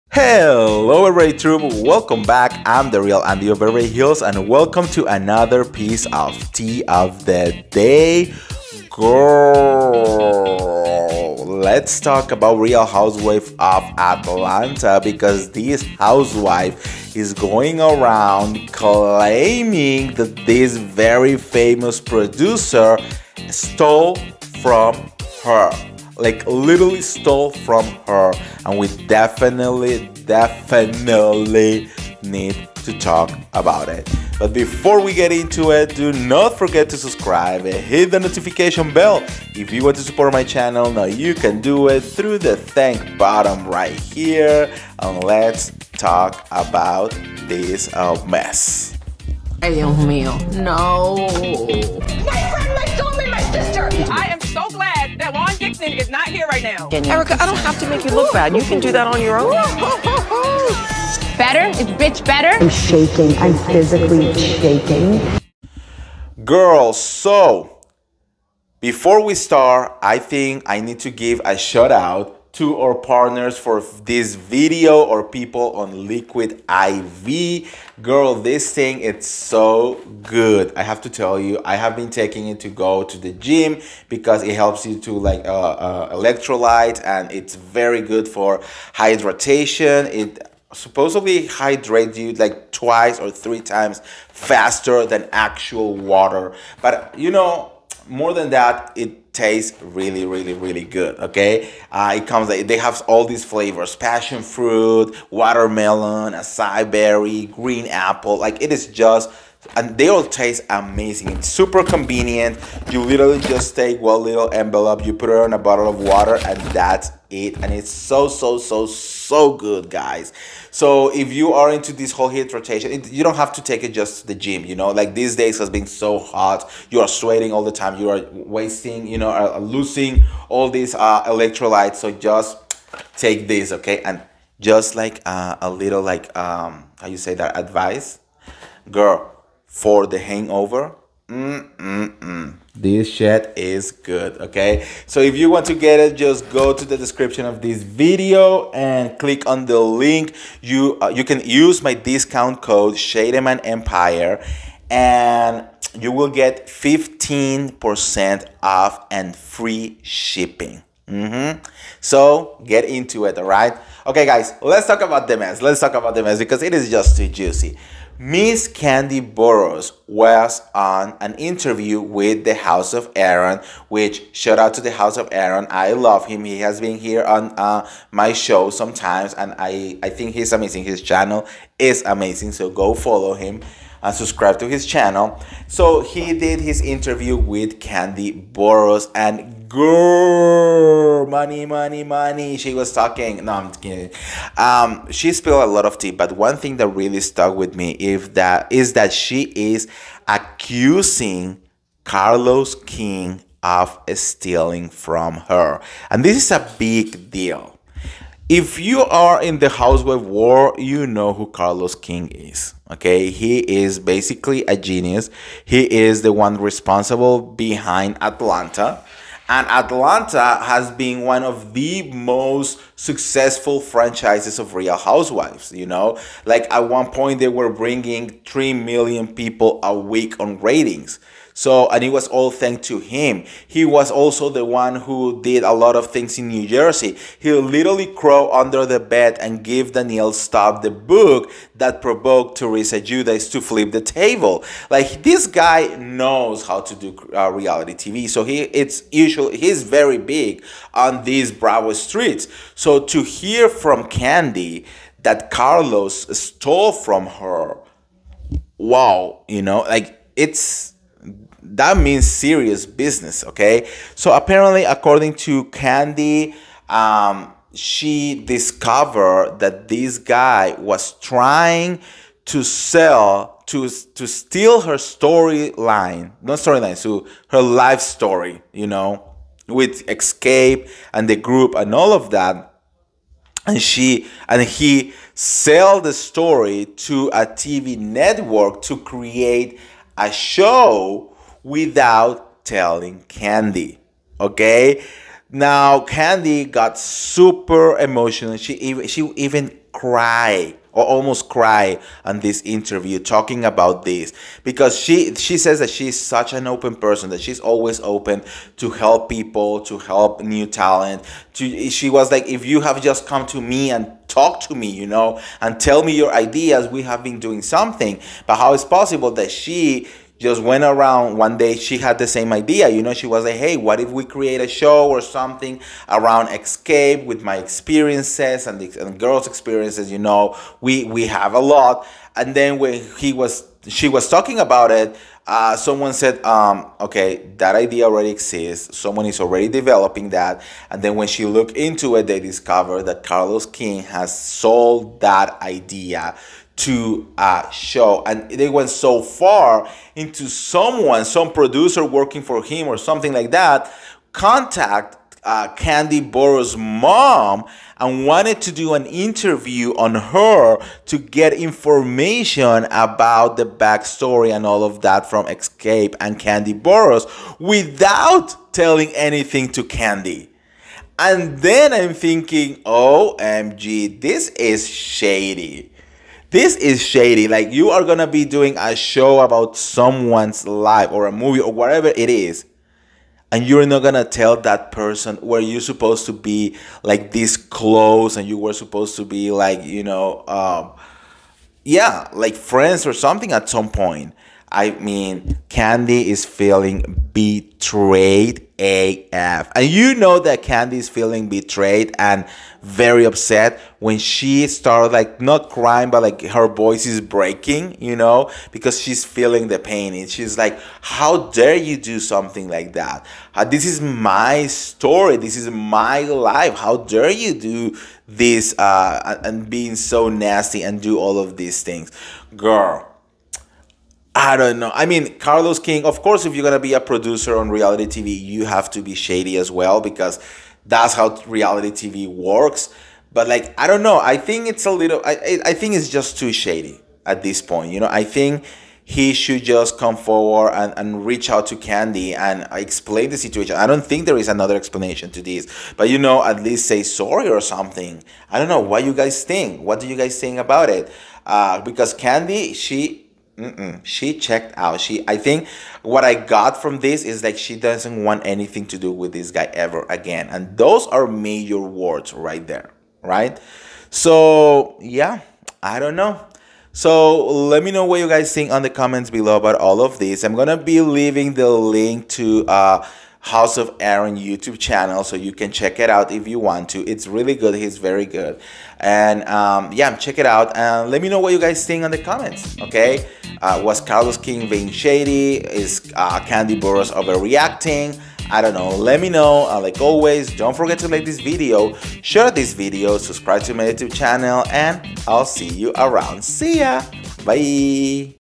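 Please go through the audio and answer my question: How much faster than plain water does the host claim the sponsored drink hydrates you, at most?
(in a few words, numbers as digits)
three times.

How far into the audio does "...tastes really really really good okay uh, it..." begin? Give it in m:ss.
1:39.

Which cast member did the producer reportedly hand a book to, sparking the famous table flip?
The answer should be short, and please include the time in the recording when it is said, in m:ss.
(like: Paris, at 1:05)
Danielle Staub, at 3:59.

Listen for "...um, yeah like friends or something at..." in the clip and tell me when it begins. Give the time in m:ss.
6:30.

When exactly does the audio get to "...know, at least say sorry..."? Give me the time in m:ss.
7:26.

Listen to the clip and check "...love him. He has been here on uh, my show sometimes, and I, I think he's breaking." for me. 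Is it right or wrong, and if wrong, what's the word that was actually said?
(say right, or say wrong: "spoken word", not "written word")
wrong: "amazing", not "breaking".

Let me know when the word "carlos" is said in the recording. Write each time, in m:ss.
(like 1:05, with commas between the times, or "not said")
3:22, 3:31, 4:15, 5:43, 7:05, 8:03.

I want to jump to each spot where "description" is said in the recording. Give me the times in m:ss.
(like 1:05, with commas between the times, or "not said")
2:26.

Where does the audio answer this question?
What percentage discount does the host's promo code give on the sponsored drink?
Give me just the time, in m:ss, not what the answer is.
2:36.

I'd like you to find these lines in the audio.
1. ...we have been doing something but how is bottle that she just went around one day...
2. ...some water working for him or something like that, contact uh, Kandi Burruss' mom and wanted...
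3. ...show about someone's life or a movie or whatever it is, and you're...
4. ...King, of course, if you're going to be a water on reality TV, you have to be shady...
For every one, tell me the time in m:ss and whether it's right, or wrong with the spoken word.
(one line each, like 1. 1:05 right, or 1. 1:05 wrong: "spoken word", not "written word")
1. 5:16 wrong: "possible", not "bottle"
2. 5:51 wrong: "producer", not "water"
3. 6:18 right
4. 7:05 wrong: "producer", not "water".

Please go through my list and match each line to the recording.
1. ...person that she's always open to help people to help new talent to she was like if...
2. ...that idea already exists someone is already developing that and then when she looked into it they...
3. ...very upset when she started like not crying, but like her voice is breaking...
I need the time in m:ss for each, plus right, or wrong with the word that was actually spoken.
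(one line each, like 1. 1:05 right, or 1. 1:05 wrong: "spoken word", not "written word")
1. 5:06 right
2. 5:37 right
3. 6:42 right.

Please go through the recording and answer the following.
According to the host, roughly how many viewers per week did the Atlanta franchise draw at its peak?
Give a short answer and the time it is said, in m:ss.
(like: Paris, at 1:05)
3 million, at 3:48.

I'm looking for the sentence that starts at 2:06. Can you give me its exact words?
You are sweating all the time.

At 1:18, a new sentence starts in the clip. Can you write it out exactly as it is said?
Girl, this thing, it's so good.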